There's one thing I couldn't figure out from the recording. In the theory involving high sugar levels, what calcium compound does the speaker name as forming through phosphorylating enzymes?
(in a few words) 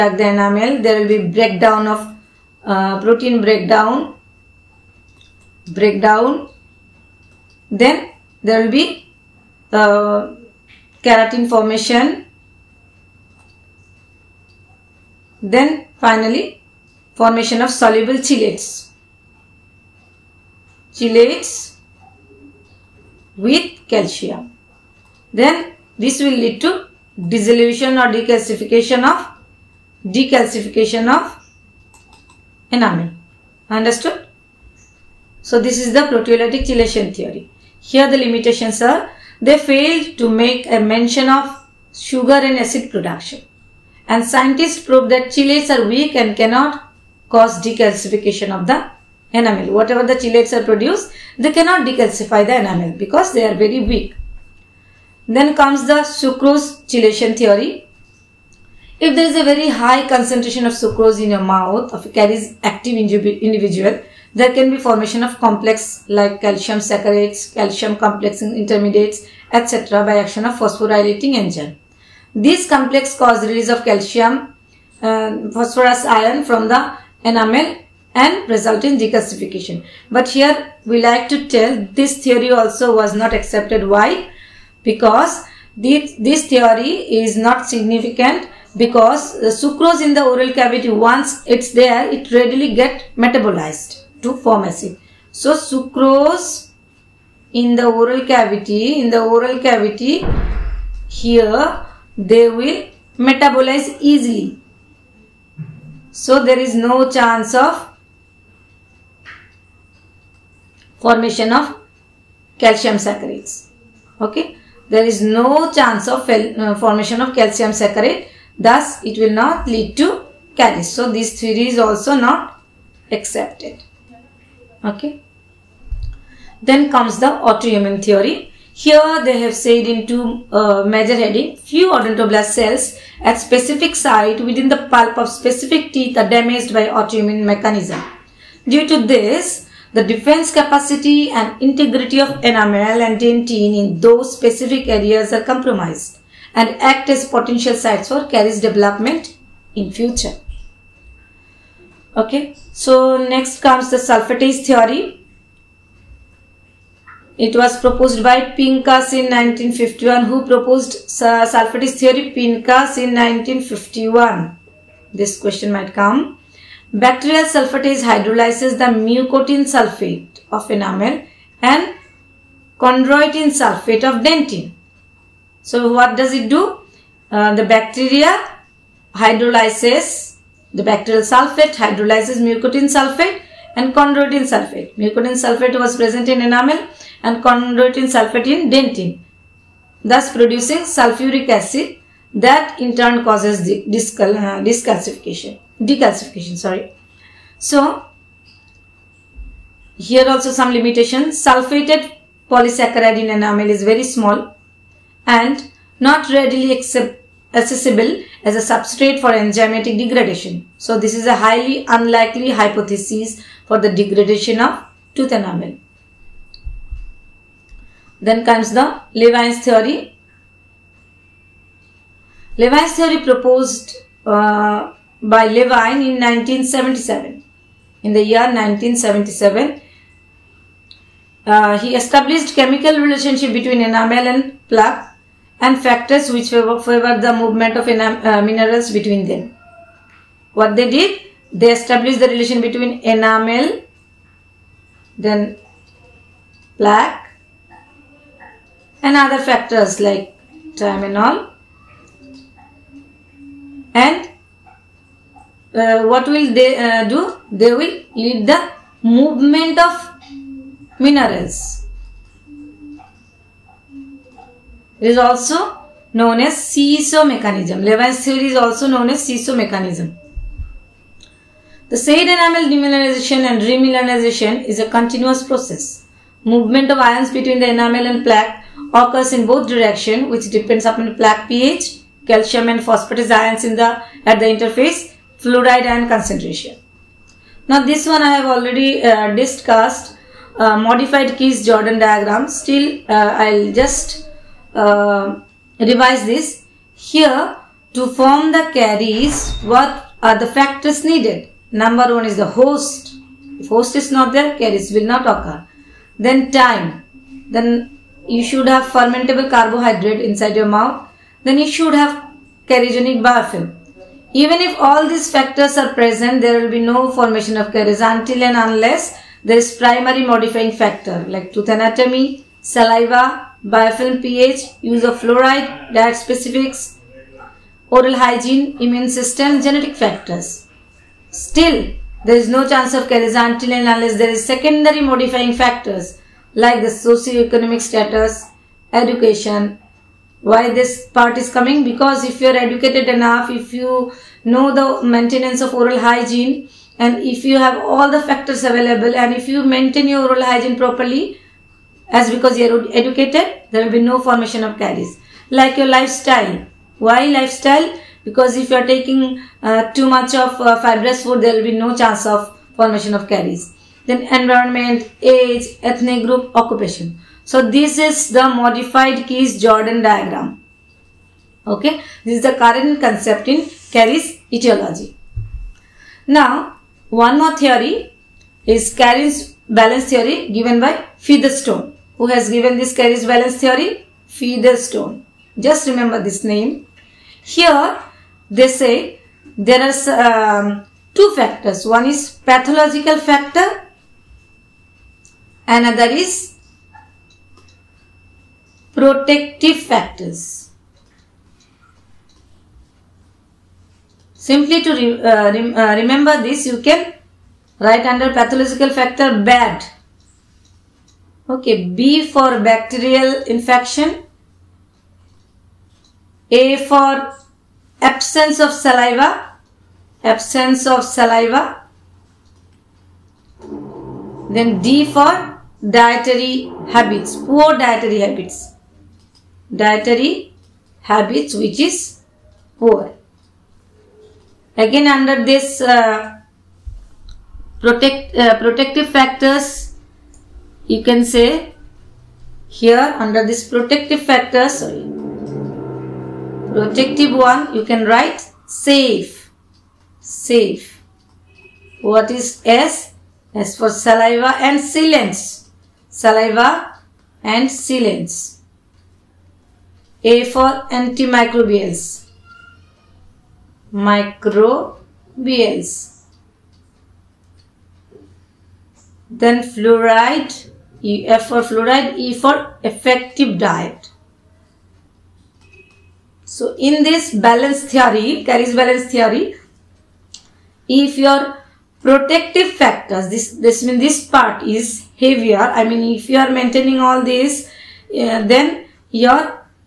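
Calcium saccharates.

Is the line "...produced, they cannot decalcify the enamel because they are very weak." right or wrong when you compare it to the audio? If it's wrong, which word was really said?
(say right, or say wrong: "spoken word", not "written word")
right.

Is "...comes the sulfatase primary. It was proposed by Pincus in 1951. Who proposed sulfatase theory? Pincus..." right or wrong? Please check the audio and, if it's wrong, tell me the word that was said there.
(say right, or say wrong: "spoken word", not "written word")
wrong: "theory", not "primary".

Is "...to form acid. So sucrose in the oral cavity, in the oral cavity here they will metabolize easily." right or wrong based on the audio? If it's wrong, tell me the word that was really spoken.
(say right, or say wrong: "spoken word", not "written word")
right.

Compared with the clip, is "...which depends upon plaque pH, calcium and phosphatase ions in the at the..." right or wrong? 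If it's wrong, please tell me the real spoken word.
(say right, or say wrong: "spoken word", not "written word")
right.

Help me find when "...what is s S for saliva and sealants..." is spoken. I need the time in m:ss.
7:32.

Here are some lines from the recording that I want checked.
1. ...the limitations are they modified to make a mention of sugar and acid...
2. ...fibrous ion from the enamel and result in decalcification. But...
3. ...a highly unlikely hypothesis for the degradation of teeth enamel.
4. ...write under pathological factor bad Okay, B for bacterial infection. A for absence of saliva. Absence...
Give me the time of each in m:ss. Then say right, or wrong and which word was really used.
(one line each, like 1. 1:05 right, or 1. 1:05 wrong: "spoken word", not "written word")
1. 0:38 wrong: "failed", not "modified"
2. 1:15 wrong: "phosphorus", not "fibrous"
3. 3:31 wrong: "tooth", not "teeth"
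4. 6:47 right.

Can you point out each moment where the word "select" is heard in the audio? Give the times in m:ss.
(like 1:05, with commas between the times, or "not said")
not said.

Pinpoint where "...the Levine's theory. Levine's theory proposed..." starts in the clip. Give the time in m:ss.
3:38.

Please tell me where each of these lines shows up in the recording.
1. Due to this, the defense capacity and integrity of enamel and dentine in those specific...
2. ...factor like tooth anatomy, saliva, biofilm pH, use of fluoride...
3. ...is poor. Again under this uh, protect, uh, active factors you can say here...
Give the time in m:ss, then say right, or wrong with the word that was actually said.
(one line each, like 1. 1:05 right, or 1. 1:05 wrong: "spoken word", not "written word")
1. 2:18 right
2. 5:20 right
3. 7:11 wrong: "protective", not "active".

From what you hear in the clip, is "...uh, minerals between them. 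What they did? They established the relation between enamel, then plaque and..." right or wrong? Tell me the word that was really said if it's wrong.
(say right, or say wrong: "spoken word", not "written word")
right.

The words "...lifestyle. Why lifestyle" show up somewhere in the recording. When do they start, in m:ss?
5:55.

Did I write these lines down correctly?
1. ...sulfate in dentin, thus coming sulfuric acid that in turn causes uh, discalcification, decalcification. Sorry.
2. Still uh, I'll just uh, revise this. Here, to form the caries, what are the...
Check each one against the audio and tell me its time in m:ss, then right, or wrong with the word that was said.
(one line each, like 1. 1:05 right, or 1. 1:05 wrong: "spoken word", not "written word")
1. 3:08 wrong: "producing", not "coming"
2. 4:52 right.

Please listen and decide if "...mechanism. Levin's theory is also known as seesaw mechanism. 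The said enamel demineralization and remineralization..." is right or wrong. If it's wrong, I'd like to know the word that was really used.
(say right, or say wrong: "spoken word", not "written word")
right.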